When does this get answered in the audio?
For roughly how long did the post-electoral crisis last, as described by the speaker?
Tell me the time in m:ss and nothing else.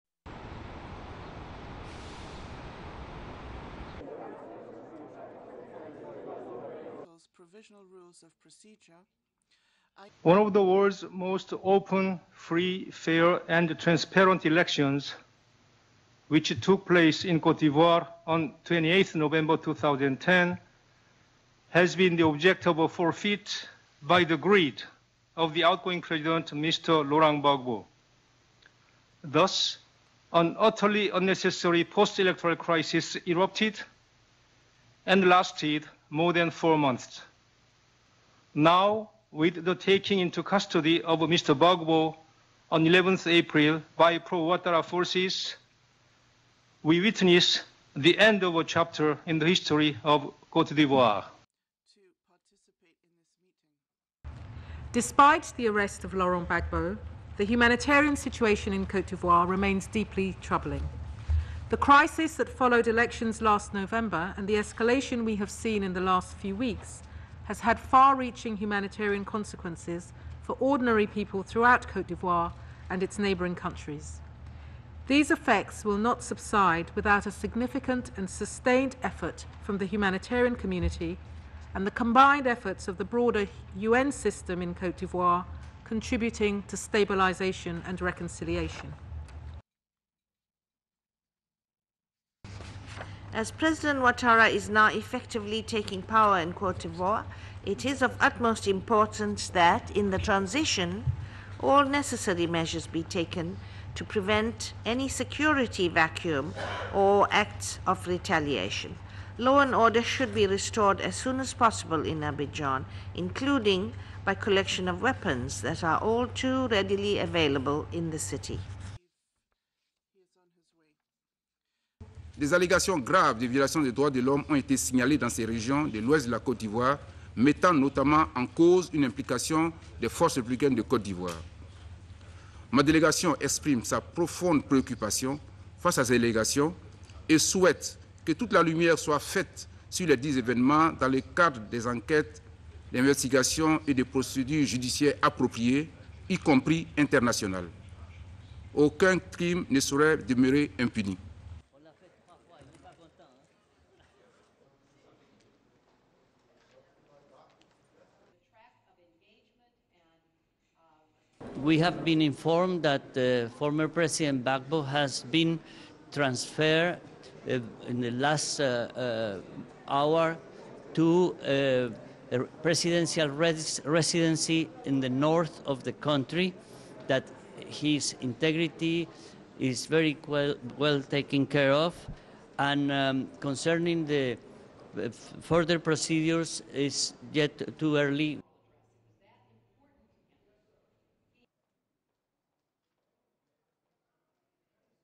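0:36.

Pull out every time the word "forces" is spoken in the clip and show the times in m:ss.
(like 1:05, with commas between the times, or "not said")
0:44, 2:10.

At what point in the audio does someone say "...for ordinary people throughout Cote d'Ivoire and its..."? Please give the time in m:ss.
1:10.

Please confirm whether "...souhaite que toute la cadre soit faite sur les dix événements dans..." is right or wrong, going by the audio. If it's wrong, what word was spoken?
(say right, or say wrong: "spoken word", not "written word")
wrong: "lumière", not "cadre".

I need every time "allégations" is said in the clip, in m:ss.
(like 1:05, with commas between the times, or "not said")
2:02, 2:16.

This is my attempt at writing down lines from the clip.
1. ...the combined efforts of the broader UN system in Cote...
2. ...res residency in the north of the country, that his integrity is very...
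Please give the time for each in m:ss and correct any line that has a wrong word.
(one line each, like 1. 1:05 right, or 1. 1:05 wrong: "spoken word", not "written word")
1. 1:21 right
2. 2:53 right.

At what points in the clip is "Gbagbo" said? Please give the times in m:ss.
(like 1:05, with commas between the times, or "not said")
0:27, 0:41, 0:56, 2:44.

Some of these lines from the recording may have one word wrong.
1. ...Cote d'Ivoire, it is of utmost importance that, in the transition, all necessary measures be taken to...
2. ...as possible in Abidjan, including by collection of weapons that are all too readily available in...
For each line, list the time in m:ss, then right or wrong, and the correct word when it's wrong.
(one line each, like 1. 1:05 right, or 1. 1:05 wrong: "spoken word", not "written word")
1. 1:36 right
2. 1:51 right.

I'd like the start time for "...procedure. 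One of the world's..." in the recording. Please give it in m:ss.
0:08.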